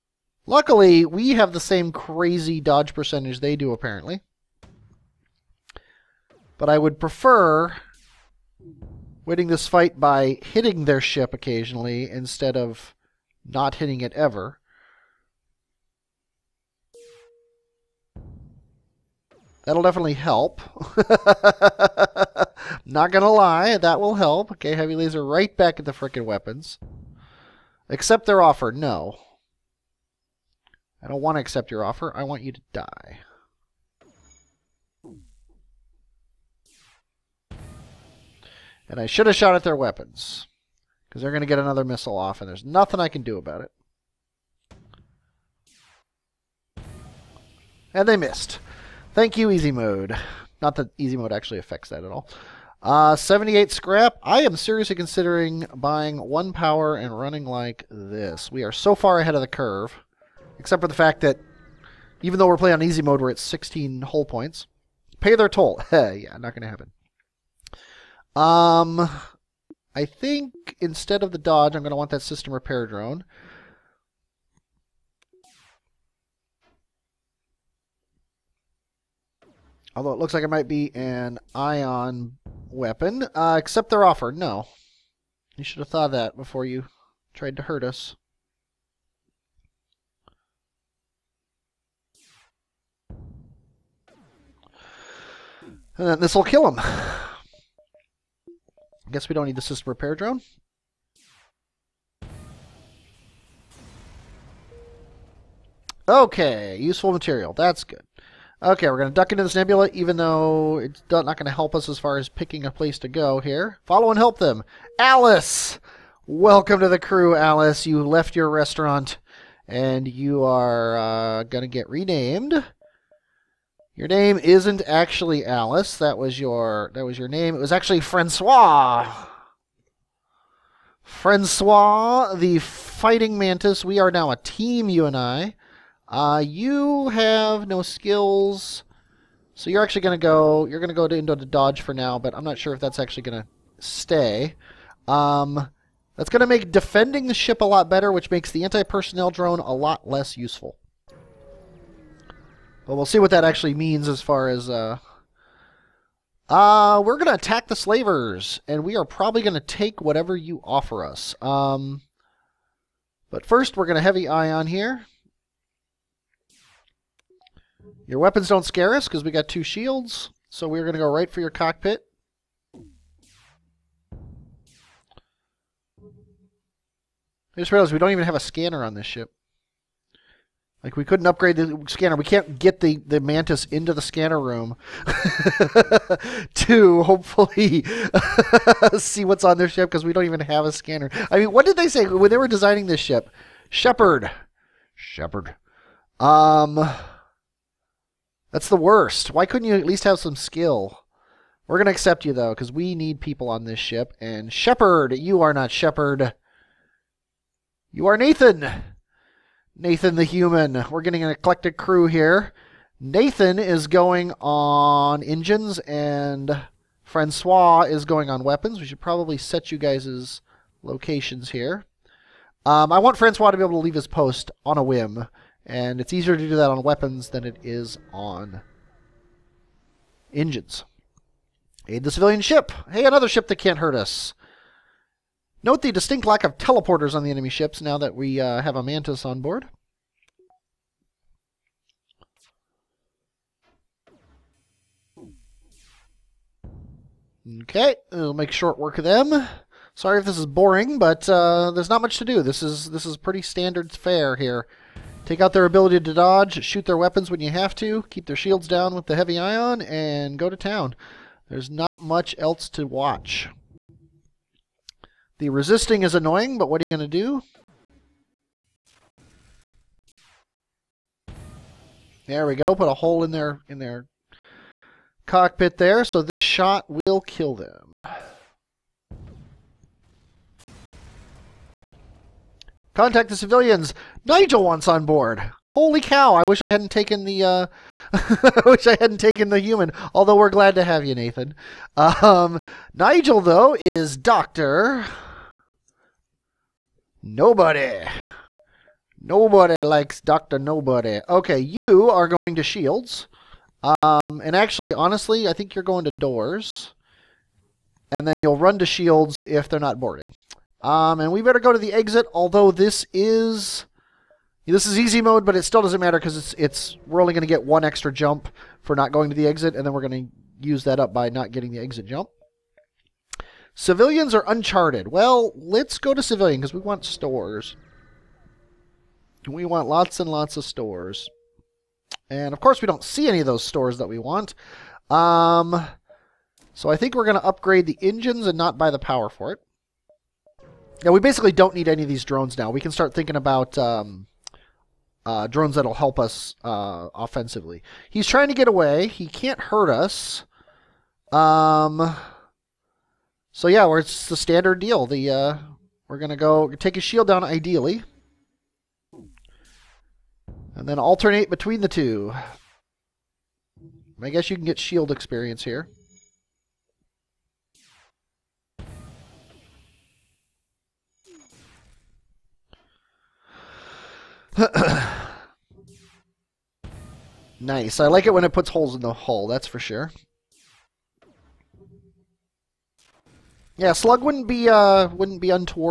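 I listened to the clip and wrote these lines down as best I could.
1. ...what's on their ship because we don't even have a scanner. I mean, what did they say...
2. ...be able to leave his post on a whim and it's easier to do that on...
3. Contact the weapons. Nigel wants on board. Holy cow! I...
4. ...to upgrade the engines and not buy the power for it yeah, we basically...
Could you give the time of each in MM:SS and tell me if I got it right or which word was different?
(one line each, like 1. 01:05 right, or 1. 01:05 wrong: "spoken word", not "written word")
1. 03:09 right
2. 03:43 right
3. 04:42 wrong: "civilians", not "weapons"
4. 05:37 right.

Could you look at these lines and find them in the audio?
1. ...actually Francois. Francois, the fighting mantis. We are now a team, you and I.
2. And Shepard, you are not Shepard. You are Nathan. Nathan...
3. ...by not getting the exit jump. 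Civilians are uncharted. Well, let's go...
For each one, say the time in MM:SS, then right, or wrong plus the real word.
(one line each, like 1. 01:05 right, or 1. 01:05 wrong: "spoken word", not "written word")
1. 02:07 right
2. 03:24 right
3. 05:21 right.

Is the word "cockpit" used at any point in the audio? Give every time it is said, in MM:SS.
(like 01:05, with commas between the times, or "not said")
02:51, 04:35.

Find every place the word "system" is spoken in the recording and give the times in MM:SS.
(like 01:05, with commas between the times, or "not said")
01:12, 01:39.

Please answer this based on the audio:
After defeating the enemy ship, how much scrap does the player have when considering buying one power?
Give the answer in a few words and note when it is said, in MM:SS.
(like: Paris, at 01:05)
78, at 00:53.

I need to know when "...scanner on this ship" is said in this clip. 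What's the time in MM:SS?
02:58.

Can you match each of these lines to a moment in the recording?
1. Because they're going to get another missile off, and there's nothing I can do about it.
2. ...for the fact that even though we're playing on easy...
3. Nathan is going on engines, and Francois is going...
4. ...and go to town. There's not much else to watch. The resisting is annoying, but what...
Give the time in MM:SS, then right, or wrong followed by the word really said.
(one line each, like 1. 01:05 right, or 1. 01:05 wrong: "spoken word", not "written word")
1. 00:41 right
2. 01:00 right
3. 03:32 right
4. 04:19 right.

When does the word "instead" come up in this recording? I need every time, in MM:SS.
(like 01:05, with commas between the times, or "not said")
00:12, 01:10.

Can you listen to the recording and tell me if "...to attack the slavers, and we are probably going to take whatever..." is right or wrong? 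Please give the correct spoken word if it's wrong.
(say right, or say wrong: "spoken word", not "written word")
right.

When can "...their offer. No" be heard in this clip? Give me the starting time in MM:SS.
00:28.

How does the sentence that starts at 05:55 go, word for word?
The uh, we're gonna go take his shield down ideally, and then alternate between the two.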